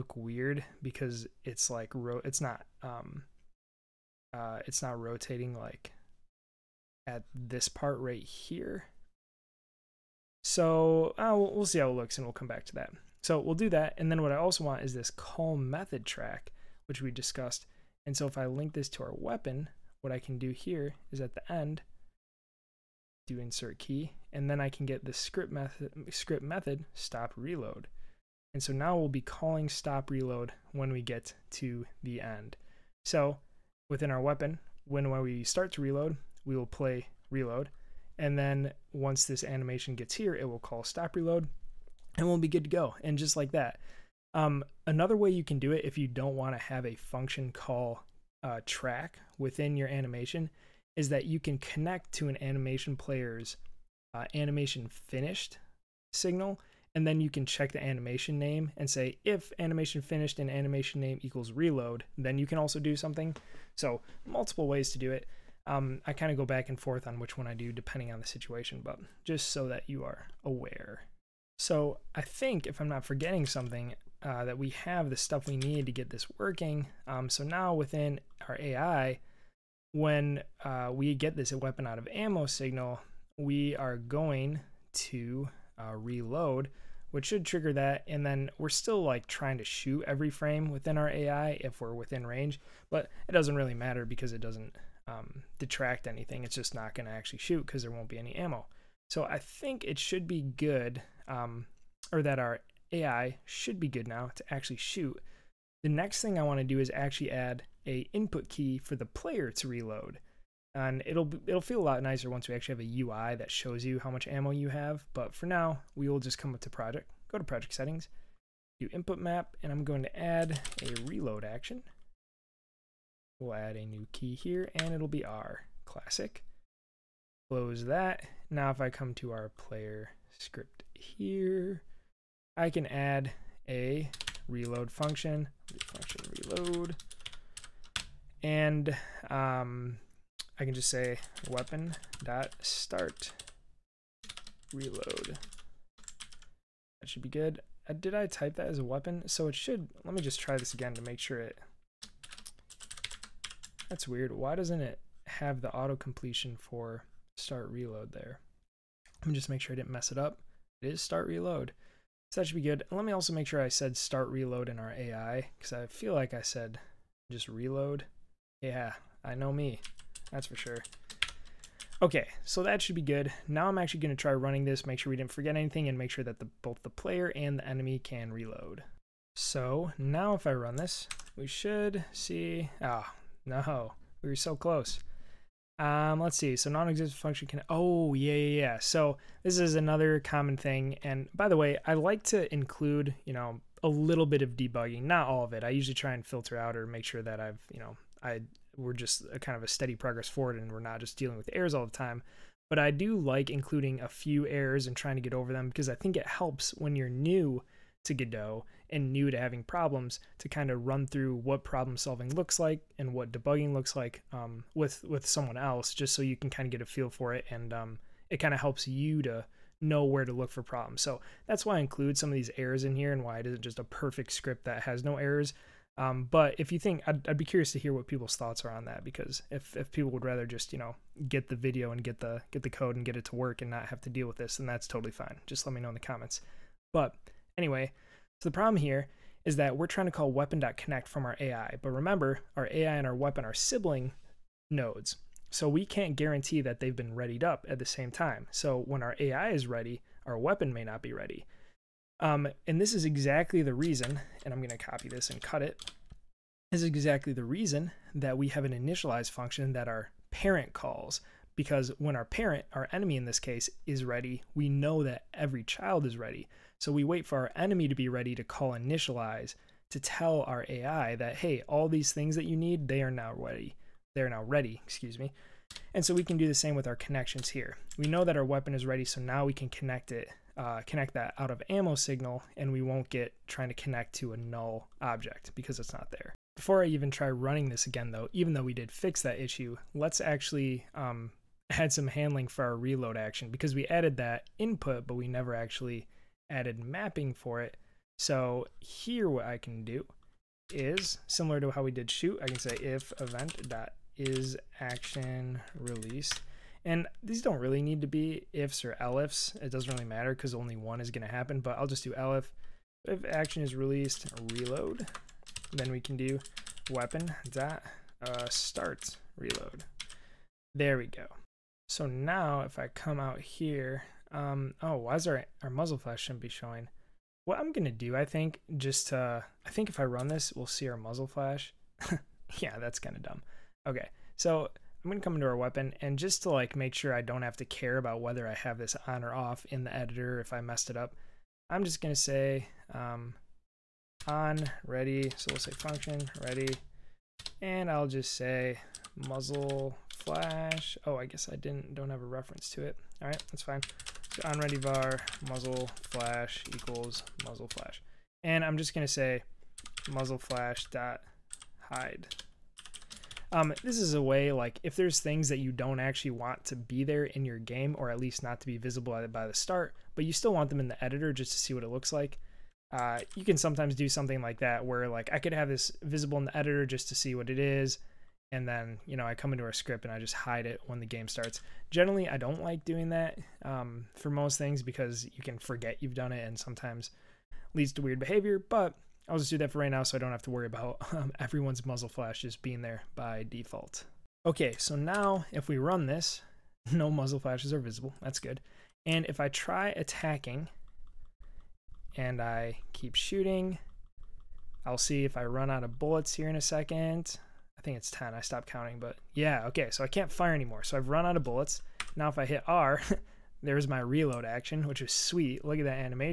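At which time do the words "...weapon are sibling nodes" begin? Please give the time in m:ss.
4:03.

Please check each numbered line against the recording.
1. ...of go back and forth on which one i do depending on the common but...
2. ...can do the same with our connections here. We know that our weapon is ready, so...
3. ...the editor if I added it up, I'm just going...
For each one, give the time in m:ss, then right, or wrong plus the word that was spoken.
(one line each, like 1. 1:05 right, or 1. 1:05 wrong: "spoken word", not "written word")
1. 1:06 wrong: "situation", not "common"
2. 4:36 right
3. 5:39 wrong: "messed", not "added".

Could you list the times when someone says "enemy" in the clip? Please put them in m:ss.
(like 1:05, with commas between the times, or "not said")
2:57, 4:22, 4:27.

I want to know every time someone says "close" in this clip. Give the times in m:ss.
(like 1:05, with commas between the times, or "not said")
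2:07, 3:04.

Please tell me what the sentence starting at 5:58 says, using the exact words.
And I'm just gonna say muzzle flash dot hide.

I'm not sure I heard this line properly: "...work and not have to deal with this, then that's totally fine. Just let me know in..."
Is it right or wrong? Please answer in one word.
right.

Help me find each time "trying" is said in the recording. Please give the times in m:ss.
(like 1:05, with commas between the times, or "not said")
1:29, 3:24, 3:59, 4:43.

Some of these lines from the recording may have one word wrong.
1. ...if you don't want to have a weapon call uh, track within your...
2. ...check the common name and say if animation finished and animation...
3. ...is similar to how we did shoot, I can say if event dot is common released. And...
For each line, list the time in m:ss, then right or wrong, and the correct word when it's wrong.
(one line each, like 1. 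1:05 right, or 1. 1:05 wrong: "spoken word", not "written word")
1. 0:45 wrong: "function", not "weapon"
2. 0:57 wrong: "animation", not "common"
3. 5:00 wrong: "action", not "common".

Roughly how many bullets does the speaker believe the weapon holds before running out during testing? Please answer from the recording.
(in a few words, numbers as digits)
10.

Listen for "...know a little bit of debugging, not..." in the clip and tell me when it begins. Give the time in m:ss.
3:13.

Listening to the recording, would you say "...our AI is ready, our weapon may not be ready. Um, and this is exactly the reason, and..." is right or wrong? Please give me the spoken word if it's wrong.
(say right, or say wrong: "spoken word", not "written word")
right.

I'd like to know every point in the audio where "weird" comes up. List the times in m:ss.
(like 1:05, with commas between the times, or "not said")
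0:00, 2:34, 6:28.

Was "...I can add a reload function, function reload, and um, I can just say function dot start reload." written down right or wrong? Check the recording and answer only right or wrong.
wrong.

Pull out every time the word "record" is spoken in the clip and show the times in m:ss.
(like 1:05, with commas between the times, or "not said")
not said.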